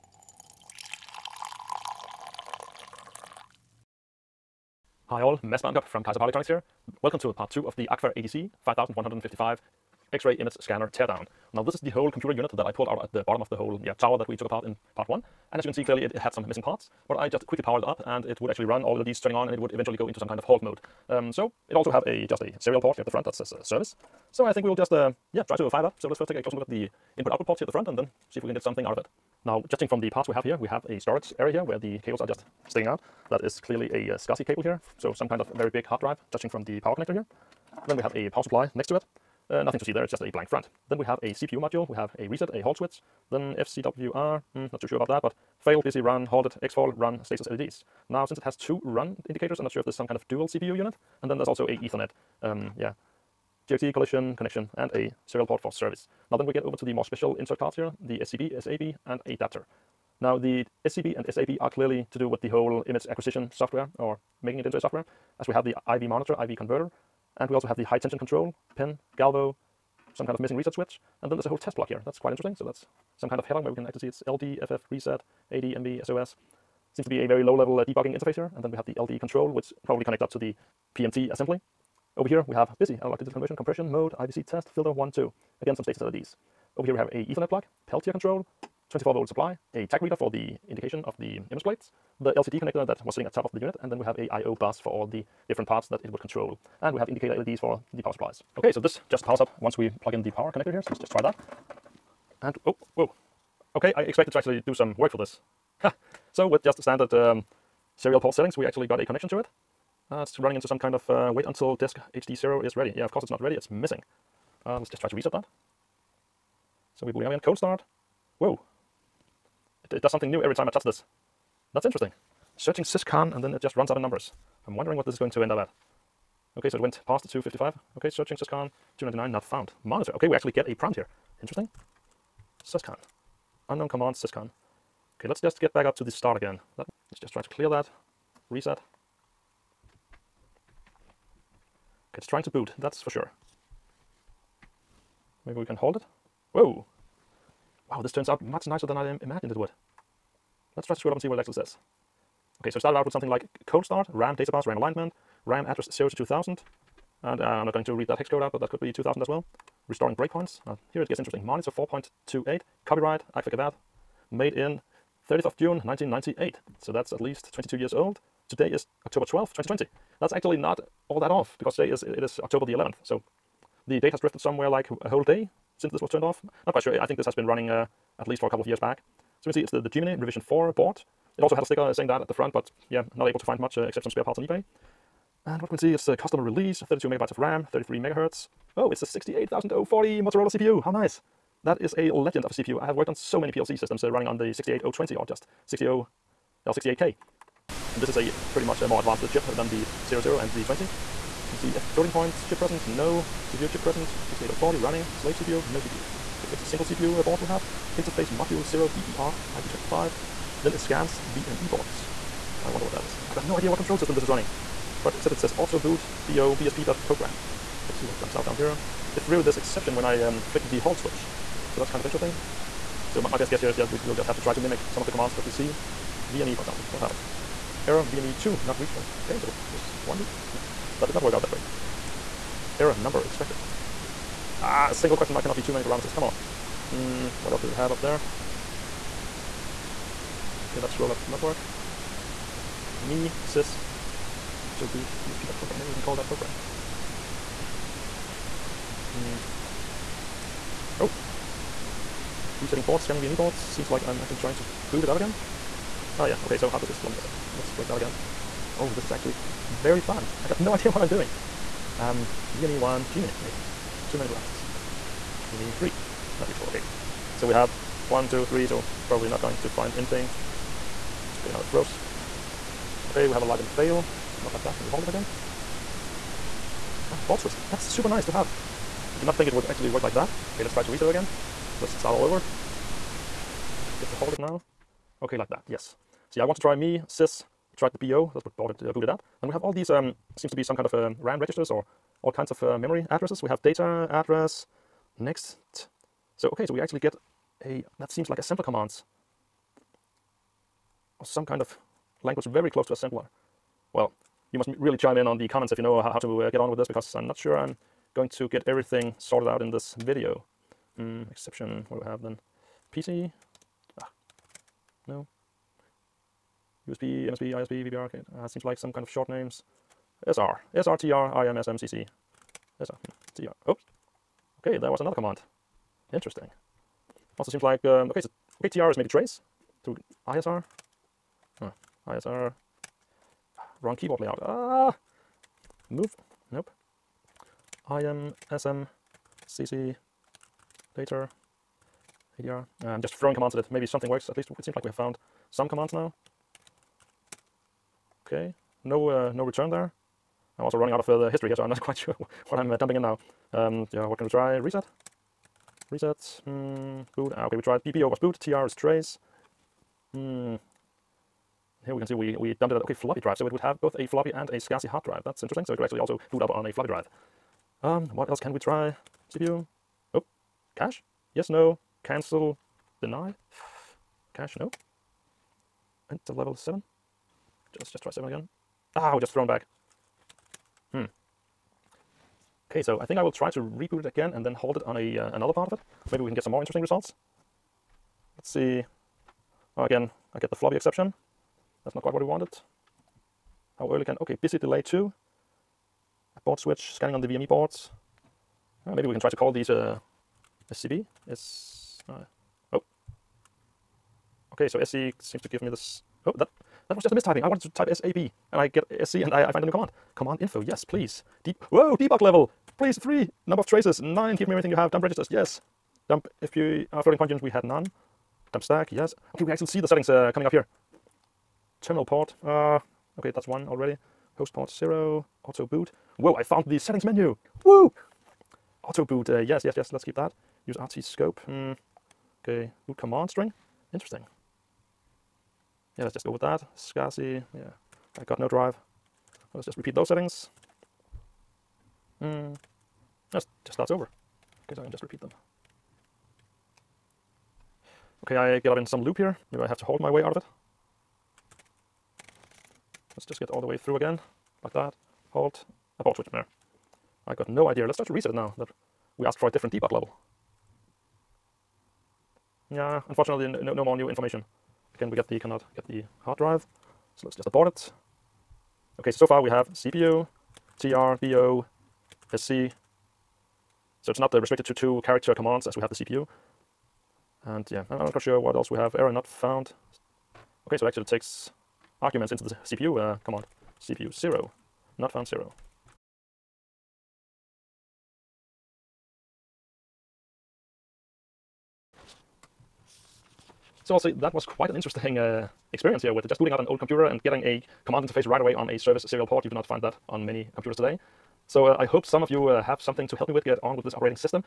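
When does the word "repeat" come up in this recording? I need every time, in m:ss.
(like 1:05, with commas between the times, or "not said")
7:19, 7:25.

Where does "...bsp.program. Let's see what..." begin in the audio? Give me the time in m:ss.
3:36.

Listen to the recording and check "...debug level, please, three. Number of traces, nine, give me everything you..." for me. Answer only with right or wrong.
right.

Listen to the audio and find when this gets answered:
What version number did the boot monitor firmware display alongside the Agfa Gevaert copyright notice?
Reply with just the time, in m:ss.
2:41.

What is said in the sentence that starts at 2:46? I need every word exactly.
So that's at least 22 years old.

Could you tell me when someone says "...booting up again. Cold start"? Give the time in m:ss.
1:57.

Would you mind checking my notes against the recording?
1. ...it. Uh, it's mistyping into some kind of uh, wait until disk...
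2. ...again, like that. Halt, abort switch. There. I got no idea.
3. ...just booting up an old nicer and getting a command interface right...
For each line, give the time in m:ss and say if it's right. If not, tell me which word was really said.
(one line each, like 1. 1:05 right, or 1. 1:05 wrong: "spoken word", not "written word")
1. 1:49 wrong: "running", not "mistyping"
2. 7:33 right
3. 8:16 wrong: "computer", not "nicer".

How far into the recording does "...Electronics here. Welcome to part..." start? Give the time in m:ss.
0:06.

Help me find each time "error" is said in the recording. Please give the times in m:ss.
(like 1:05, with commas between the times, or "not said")
3:47, 3:52, 7:58.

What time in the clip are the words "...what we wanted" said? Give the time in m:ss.
6:32.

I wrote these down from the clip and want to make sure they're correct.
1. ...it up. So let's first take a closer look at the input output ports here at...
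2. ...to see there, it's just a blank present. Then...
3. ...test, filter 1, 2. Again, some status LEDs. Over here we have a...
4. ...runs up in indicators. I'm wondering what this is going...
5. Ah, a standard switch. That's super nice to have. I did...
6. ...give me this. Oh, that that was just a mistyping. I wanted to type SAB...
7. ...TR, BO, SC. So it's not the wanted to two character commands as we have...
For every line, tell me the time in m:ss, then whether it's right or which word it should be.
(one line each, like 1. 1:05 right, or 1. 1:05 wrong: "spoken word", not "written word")
1. 0:25 right
2. 0:39 wrong: "front", not "present"
3. 1:24 right
4. 2:03 wrong: "numbers", not "indicators"
5. 4:37 wrong: "board", not "standard"
6. 6:45 right
7. 7:50 wrong: "restricted", not "wanted".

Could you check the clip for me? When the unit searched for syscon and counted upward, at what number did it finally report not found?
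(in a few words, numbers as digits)
299.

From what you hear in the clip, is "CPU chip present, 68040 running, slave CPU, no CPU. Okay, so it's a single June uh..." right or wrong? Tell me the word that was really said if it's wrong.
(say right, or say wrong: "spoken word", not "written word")
wrong: "CPU", not "June".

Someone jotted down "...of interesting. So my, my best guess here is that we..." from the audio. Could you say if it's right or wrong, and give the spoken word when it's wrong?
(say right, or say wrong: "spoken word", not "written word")
right.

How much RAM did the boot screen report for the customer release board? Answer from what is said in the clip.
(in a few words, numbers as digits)
32 megabytes.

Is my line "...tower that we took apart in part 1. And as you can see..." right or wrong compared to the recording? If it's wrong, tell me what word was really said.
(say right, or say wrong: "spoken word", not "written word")
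right.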